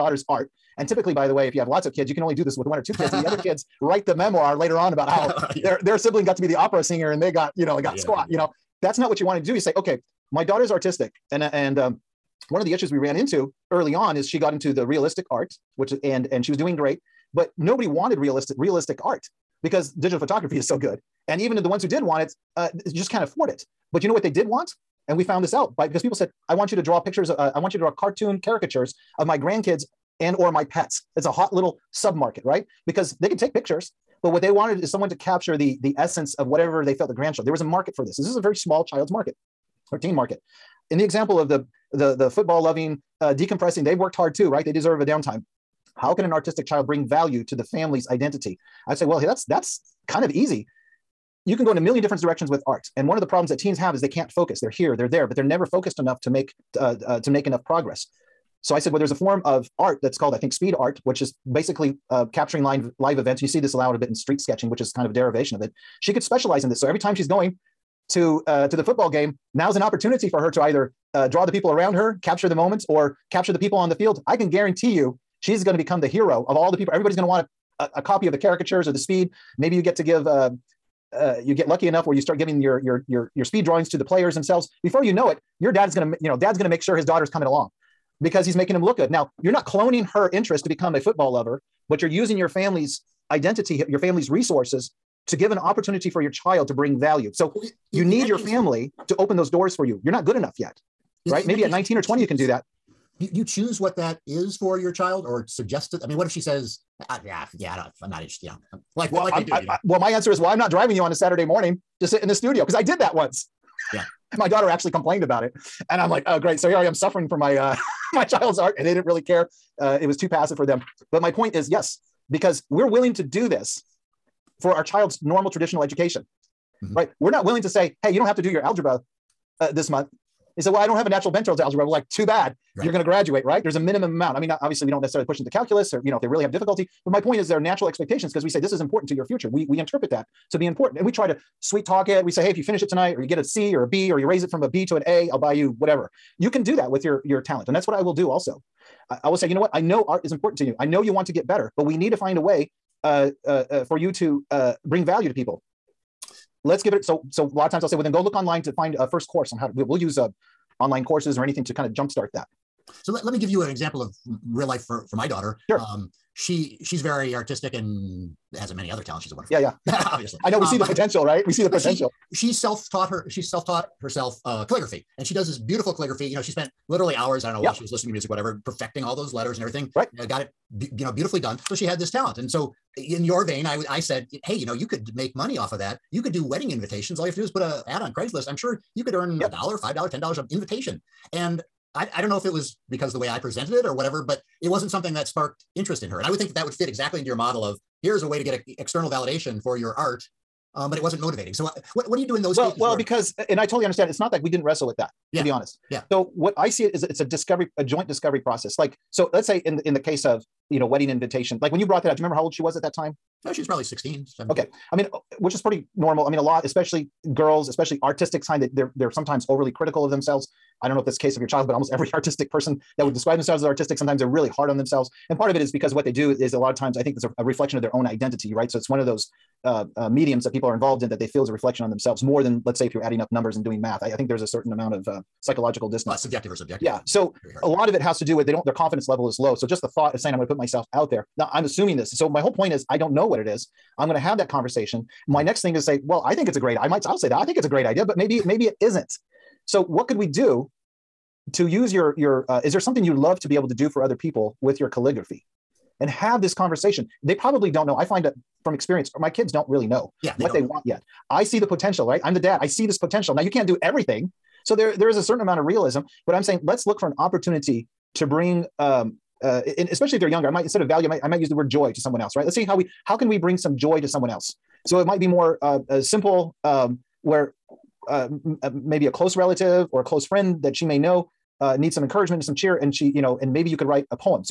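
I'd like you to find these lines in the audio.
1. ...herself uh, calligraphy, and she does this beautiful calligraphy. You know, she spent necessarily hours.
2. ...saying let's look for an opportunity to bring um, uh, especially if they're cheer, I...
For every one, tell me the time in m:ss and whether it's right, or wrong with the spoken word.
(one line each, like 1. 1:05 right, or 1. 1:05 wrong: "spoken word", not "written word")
1. 2:54 wrong: "literally", not "necessarily"
2. 4:26 wrong: "younger", not "cheer".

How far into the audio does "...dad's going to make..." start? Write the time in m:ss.
1:26.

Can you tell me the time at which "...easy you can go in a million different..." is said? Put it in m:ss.
0:50.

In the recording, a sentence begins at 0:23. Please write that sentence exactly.
But you know what they did want, and we found this out by because people said, "I want you to draw pictures.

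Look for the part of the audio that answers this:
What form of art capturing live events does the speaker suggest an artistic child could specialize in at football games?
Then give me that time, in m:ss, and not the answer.
1:00.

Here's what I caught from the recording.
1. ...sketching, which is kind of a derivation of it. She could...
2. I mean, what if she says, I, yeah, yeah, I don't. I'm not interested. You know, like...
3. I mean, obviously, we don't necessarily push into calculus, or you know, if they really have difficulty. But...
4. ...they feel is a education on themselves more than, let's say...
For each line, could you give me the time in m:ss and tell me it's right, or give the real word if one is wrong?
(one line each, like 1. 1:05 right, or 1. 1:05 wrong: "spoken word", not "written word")
1. 1:04 right
2. 1:46 right
3. 2:14 right
4. 3:51 wrong: "reflection", not "education".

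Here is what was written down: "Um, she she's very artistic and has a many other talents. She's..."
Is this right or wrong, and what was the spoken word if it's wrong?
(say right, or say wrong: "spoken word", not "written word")
right.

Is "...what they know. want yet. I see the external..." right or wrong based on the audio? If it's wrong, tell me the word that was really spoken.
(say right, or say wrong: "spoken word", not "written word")
wrong: "potential", not "external".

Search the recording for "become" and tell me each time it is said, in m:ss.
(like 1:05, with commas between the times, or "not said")
1:15, 1:30.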